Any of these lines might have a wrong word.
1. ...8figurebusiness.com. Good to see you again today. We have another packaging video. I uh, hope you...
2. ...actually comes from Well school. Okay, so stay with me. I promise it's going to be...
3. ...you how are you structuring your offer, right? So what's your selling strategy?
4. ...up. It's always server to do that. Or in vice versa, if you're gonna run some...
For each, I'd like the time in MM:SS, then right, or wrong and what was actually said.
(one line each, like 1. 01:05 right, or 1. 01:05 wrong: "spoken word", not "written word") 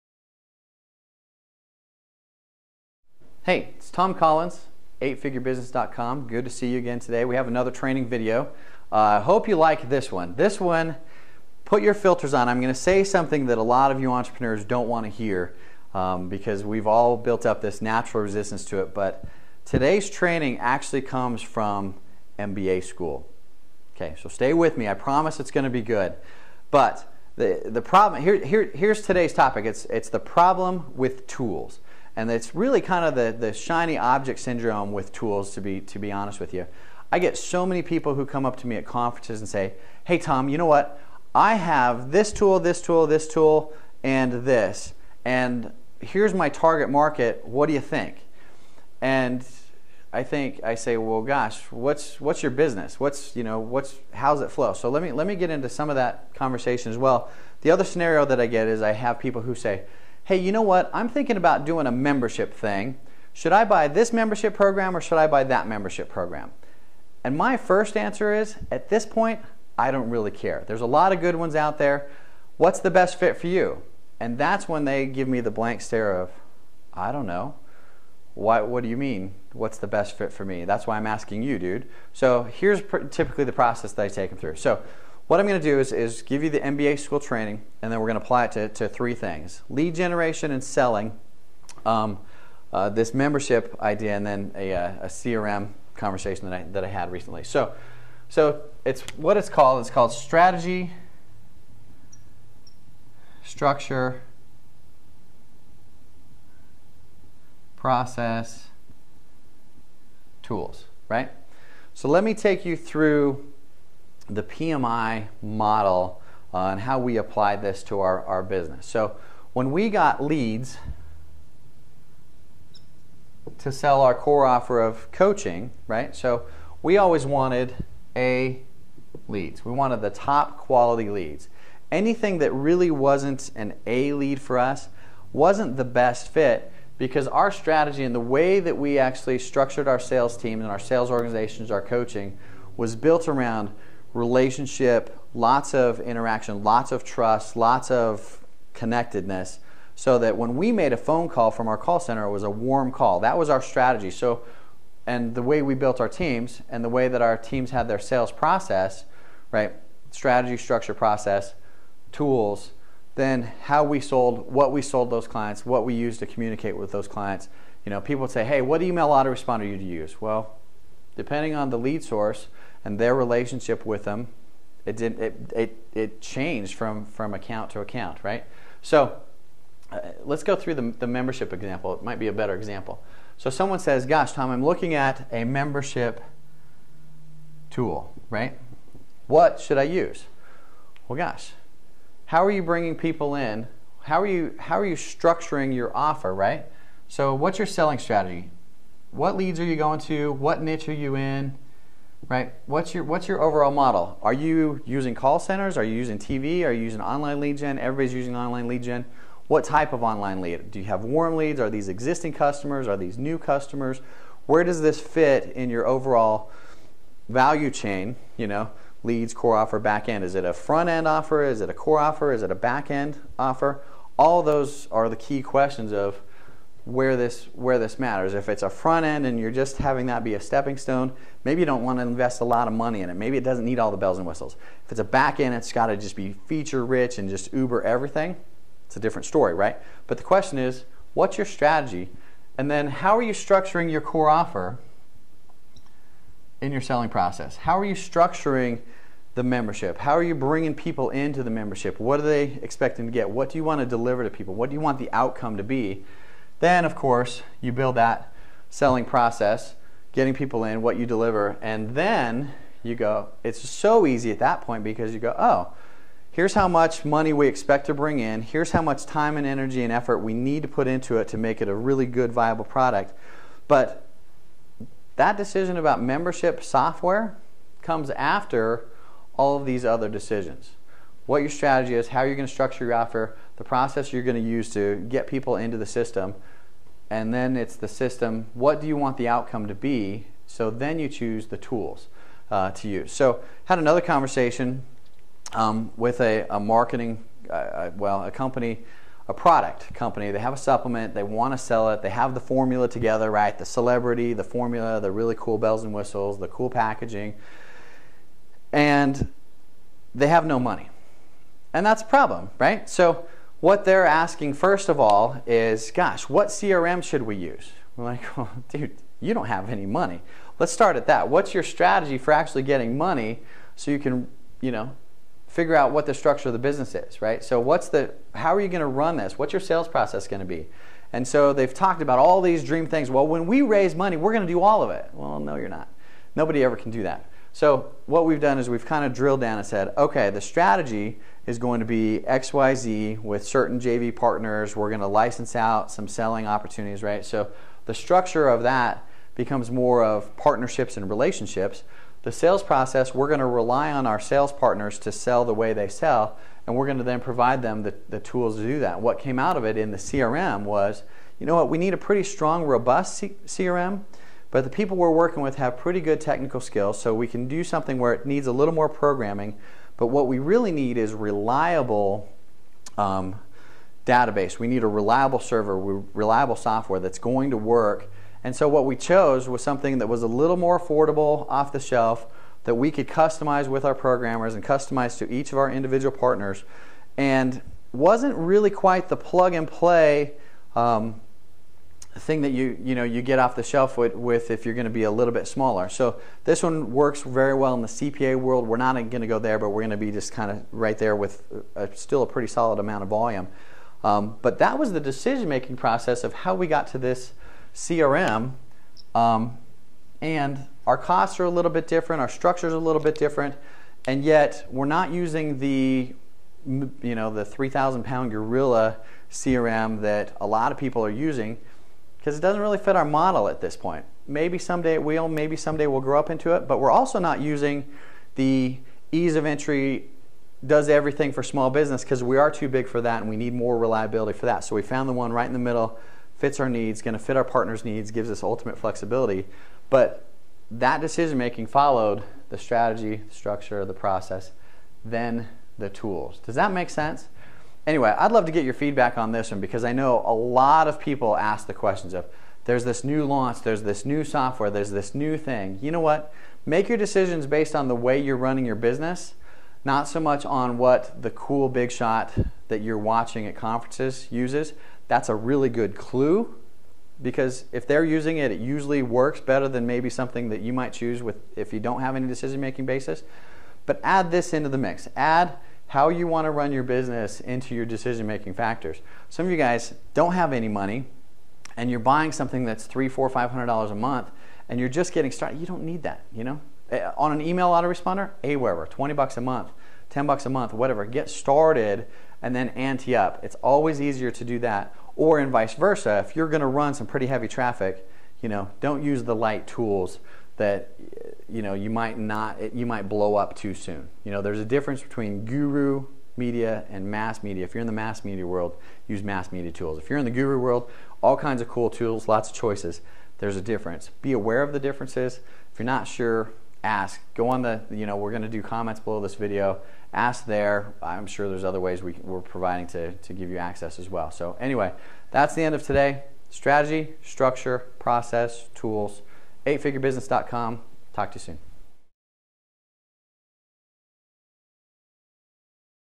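1. 00:05 wrong: "training", not "packaging"
2. 00:20 wrong: "MBA", not "Well"
3. 03:14 right
4. 08:13 wrong: "easier", not "server".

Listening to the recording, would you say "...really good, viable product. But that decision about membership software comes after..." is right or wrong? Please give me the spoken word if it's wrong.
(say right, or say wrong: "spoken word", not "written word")
right.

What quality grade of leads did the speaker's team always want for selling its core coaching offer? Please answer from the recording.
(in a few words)
A leads.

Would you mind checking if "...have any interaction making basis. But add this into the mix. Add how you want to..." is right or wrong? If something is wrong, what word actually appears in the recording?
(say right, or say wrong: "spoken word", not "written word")
wrong: "decision", not "interaction".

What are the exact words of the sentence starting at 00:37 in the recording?
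I get so many people who come up to me at conferences and say, hey, Tom, you know what?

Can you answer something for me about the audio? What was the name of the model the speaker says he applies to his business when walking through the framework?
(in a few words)
PMI model.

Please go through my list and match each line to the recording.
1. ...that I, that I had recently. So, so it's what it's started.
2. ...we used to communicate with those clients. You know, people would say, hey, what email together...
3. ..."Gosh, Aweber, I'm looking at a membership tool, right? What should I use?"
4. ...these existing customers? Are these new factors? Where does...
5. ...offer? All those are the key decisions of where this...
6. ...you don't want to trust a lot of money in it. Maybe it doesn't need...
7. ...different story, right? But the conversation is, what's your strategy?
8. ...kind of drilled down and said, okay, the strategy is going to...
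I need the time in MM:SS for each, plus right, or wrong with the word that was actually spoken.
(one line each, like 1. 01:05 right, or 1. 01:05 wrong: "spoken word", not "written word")
1. 01:36 wrong: "called", not "started"
2. 02:45 wrong: "autoresponder", not "together"
3. 03:04 wrong: "Tom", not "Aweber"
4. 03:31 wrong: "customers", not "factors"
5. 03:43 wrong: "questions", not "decisions"
6. 03:51 wrong: "invest", not "trust"
7. 03:58 wrong: "question", not "conversation"
8. 05:38 right.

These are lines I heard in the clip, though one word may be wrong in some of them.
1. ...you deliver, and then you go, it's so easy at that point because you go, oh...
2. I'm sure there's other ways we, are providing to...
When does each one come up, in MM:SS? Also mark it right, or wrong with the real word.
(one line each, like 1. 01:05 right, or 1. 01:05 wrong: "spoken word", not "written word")
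1. 04:20 right
2. 08:41 right.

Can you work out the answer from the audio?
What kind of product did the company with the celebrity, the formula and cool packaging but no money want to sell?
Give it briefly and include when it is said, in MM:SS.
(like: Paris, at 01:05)
a supplement, at 05:00.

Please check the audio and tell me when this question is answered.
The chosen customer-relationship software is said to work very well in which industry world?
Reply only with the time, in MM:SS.
06:37.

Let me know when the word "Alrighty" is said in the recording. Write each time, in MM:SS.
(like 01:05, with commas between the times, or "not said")
not said.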